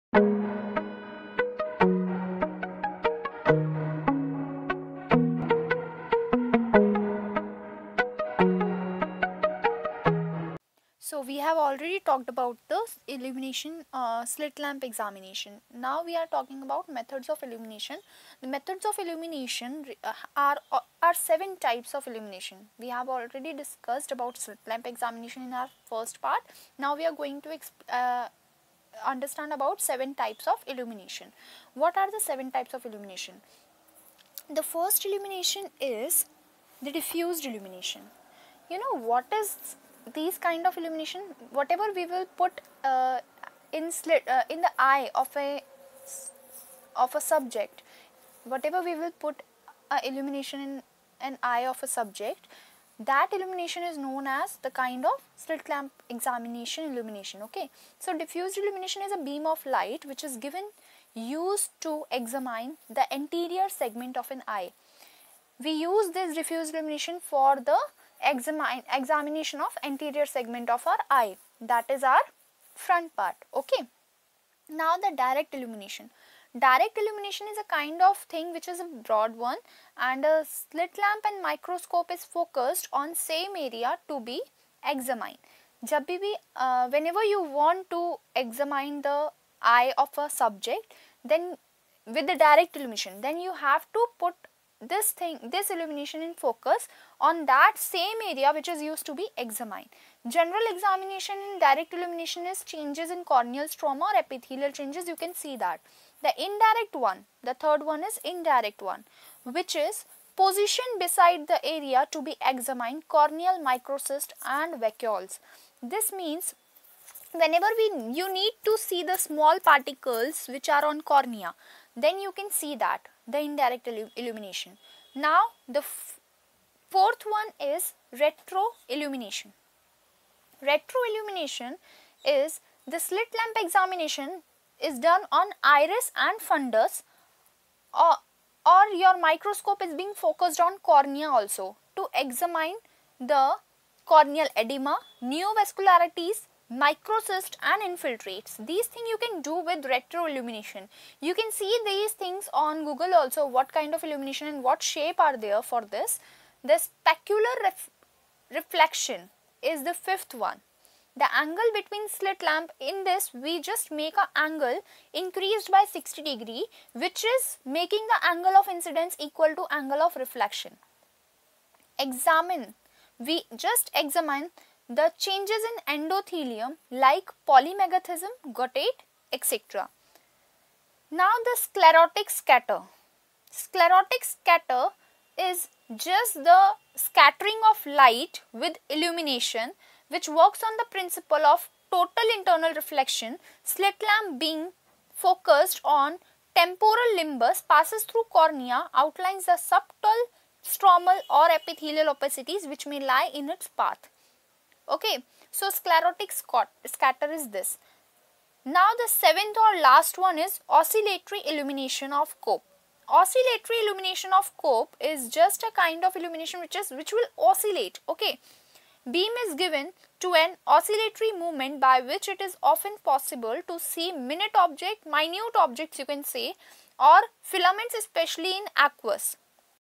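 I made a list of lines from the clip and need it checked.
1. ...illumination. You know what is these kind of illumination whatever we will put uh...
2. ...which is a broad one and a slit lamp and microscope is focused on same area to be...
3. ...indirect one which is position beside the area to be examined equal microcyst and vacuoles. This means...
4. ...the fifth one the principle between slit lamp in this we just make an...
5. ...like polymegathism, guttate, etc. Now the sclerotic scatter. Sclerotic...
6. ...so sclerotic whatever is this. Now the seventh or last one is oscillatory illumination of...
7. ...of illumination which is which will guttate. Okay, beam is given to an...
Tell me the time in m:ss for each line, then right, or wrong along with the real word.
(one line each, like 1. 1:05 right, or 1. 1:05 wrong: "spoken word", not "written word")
1. 0:37 right
2. 1:18 right
3. 1:48 wrong: "corneal", not "equal"
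4. 2:39 wrong: "angle", not "principle"
5. 2:56 right
6. 3:25 wrong: "scatter", not "whatever"
7. 3:36 wrong: "oscillate", not "guttate".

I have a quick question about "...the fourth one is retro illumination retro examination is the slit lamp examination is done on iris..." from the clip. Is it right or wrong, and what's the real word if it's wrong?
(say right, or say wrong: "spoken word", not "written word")
wrong: "illumination", not "examination".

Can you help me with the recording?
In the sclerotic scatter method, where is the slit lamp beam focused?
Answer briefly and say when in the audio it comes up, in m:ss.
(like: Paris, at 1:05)
Temporal limbus, at 3:16.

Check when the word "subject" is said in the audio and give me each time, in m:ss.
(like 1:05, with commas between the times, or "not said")
0:47, 0:51, 1:30.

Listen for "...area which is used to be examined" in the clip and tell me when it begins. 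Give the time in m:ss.
1:38.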